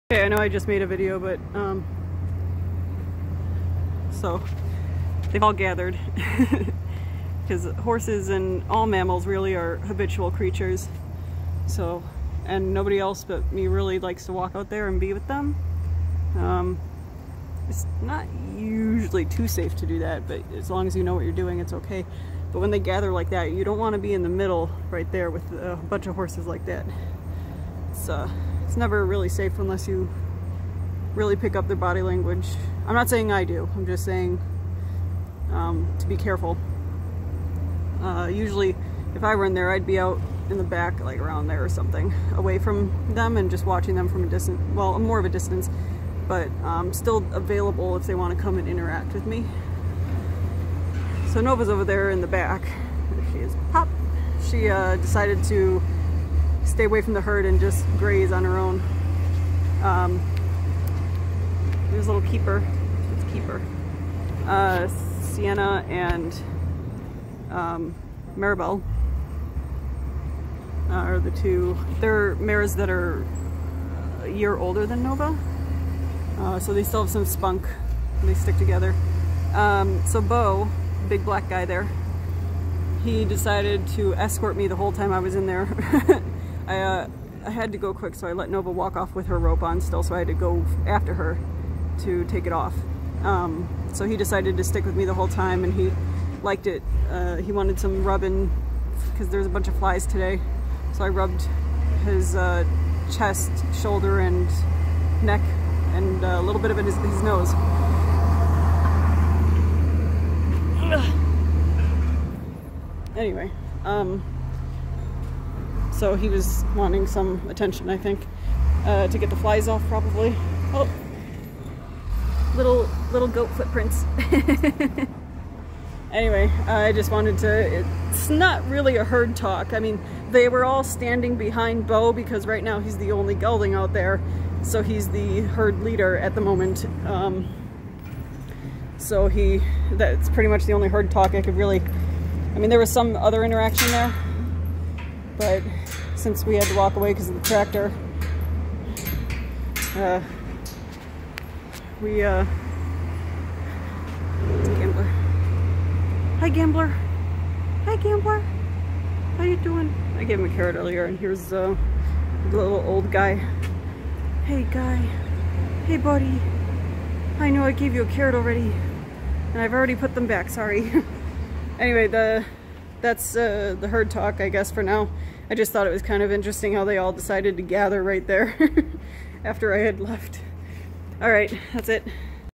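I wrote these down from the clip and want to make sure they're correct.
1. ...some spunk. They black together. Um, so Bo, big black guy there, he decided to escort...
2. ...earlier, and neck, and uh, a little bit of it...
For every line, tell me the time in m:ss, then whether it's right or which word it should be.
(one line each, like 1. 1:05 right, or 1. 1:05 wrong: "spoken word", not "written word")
1. 1:17 wrong: "stick", not "black"
2. 1:43 wrong: "shoulder", not "earlier".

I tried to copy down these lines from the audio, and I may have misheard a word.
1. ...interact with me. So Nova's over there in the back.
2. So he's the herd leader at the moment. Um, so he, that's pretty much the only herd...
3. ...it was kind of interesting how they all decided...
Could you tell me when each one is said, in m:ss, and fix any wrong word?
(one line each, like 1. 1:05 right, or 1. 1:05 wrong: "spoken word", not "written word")
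1. 0:48 right
2. 2:14 right
3. 2:55 right.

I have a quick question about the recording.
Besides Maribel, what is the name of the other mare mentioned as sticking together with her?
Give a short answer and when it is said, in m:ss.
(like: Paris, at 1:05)
Sienna, at 1:05.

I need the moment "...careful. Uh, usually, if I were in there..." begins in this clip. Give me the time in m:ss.
0:36.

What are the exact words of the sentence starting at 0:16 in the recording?
Um, it's not usually too safe to do that, but as long as you know what you're doing, it's okay.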